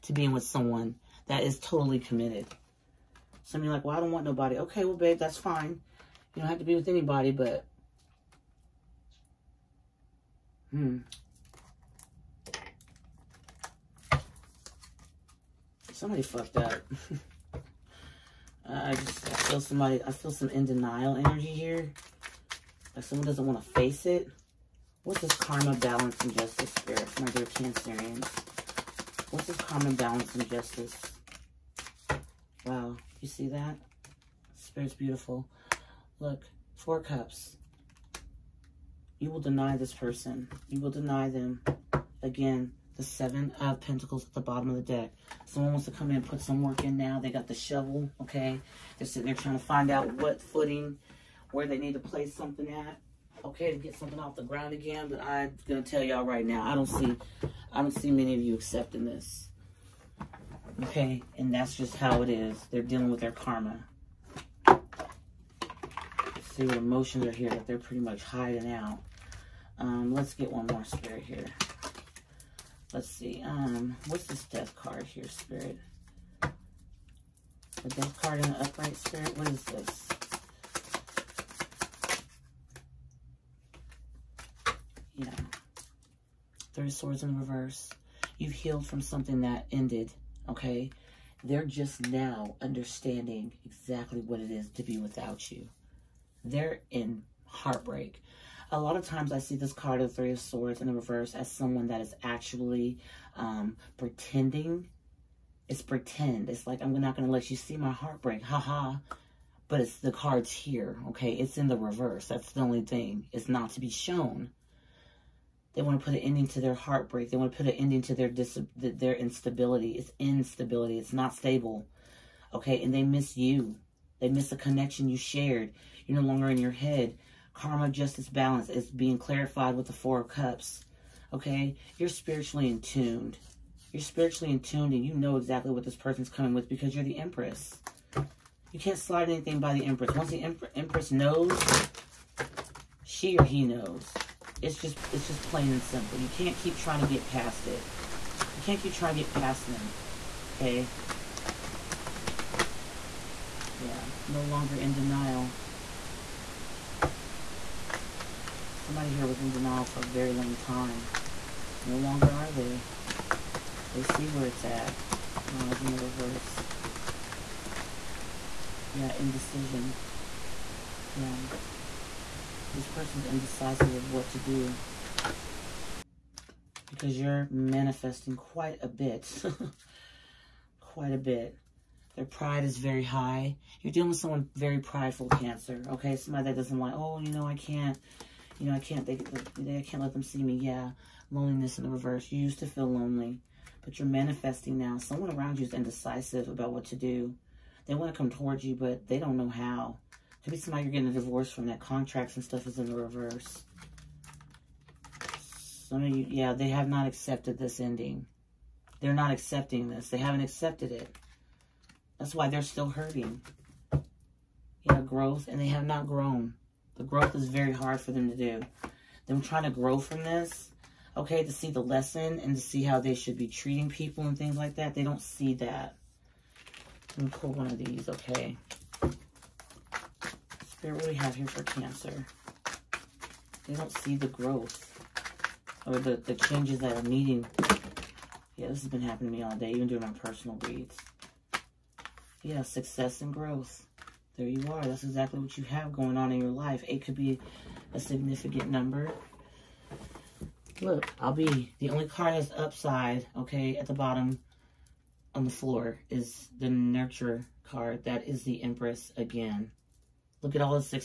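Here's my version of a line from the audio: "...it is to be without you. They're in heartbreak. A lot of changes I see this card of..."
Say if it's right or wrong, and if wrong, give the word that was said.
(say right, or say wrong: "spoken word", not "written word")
wrong: "times", not "changes".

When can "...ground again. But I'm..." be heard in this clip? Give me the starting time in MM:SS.
00:54.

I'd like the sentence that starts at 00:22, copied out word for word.
Like someone doesn't want to face it.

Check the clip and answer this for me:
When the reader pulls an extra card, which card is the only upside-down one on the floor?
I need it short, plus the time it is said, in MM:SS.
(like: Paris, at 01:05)
Nurture, at 04:16.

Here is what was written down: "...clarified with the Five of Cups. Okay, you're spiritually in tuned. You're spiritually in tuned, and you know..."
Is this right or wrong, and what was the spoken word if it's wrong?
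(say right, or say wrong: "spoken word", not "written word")
wrong: "Four", not "Five".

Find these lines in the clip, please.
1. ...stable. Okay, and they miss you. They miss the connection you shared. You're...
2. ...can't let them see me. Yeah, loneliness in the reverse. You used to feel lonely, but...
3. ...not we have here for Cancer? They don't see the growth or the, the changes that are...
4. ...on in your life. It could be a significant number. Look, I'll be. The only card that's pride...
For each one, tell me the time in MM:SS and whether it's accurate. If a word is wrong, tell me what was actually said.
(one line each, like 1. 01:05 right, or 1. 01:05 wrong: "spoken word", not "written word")
1. 02:01 right
2. 03:09 right
3. 03:51 right
4. 04:06 wrong: "upside", not "pride".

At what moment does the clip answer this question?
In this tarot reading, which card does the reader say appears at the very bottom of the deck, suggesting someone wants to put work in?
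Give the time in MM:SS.
00:42.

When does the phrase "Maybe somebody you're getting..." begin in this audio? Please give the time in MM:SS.
03:20.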